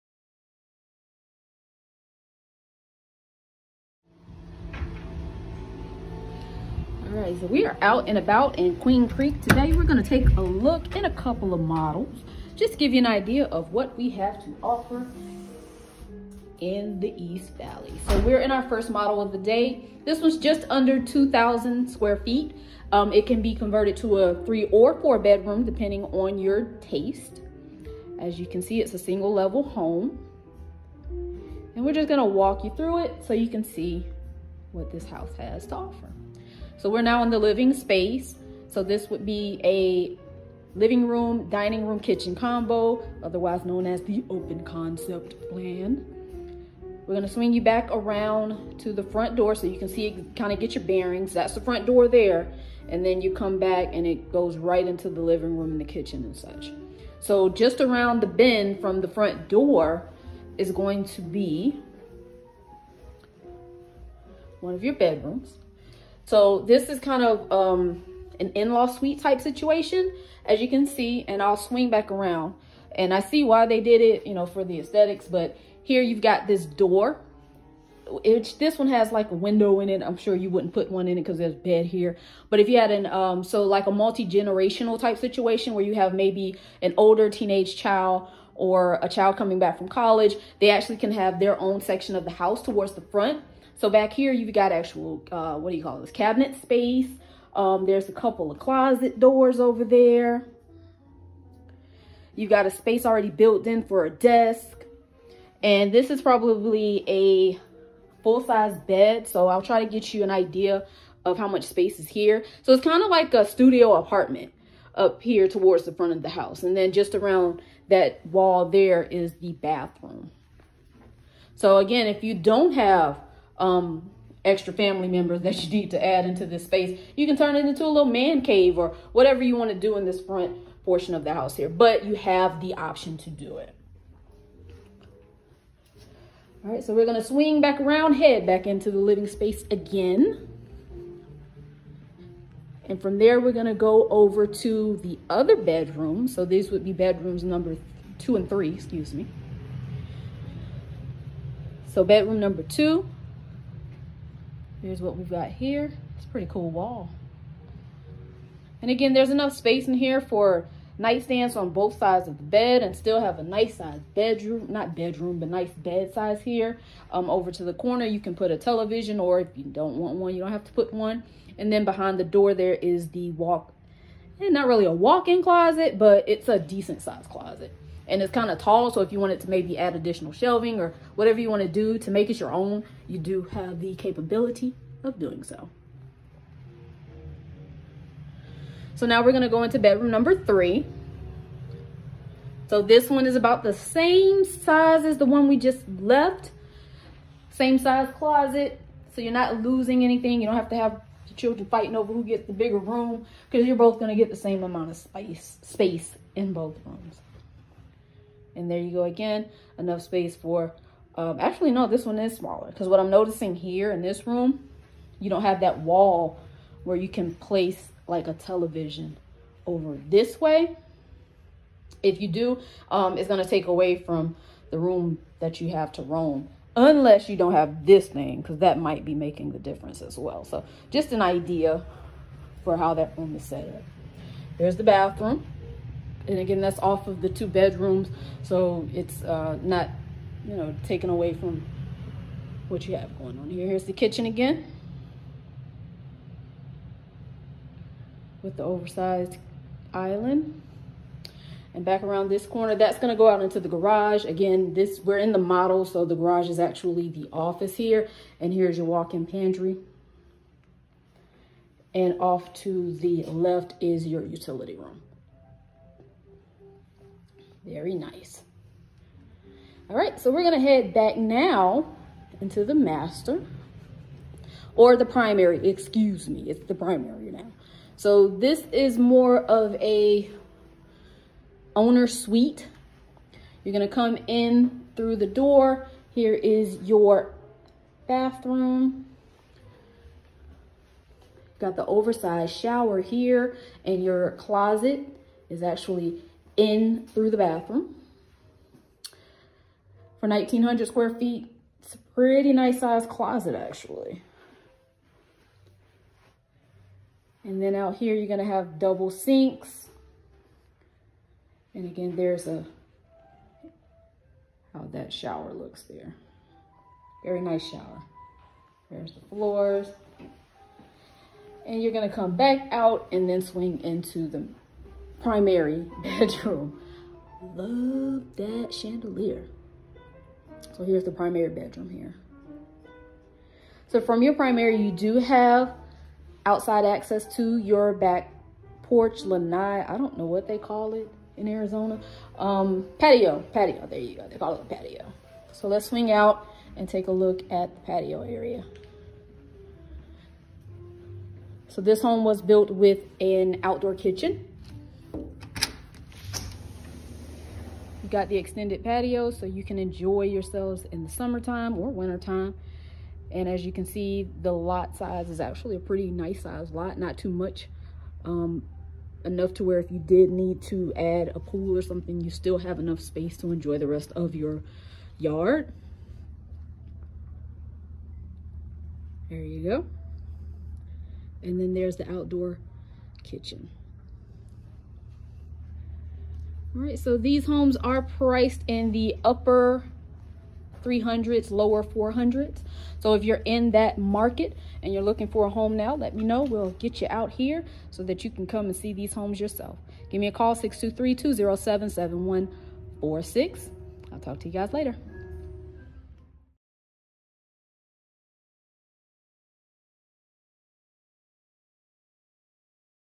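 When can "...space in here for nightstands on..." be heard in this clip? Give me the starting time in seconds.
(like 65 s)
159 s.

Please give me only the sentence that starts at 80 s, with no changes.
I'm sure you wouldn't put one in it because there's bed here.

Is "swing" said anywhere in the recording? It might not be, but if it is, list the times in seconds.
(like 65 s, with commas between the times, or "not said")
47 s, 71 s, 137 s, 323 s, 345 s.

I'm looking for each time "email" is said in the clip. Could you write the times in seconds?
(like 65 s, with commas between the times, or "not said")
not said.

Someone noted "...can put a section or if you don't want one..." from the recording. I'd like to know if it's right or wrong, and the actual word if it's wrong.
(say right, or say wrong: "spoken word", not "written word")
wrong: "television", not "section".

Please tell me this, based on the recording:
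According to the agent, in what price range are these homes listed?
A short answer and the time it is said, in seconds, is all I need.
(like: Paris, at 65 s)
Upper 300s, lower 400s, at 389 s.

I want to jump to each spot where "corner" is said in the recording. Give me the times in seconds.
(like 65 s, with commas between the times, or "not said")
167 s, 252 s.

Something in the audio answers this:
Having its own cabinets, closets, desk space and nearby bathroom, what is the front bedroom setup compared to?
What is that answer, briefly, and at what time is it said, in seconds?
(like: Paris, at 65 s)
Studio apartment, at 113 s.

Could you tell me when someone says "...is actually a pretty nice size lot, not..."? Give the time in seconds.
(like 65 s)
365 s.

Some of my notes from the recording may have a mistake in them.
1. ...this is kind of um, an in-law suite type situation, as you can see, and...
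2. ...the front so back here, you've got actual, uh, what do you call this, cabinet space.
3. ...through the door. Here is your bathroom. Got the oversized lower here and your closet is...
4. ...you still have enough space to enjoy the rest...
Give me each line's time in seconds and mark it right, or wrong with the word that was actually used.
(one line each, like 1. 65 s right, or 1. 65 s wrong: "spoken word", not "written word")
1. 66 s right
2. 92 s right
3. 284 s wrong: "shower", not "lower"
4. 372 s right.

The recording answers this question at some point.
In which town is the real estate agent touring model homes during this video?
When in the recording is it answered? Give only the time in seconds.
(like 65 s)
8 s.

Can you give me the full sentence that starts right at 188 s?
So now we're going to go into bedroom number three.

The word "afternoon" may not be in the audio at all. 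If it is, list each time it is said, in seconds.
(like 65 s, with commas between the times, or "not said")
not said.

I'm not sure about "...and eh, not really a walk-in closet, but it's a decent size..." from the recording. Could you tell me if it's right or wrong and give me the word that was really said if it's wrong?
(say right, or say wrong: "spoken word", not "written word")
right.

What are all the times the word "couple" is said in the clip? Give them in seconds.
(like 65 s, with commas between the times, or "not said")
11 s, 98 s.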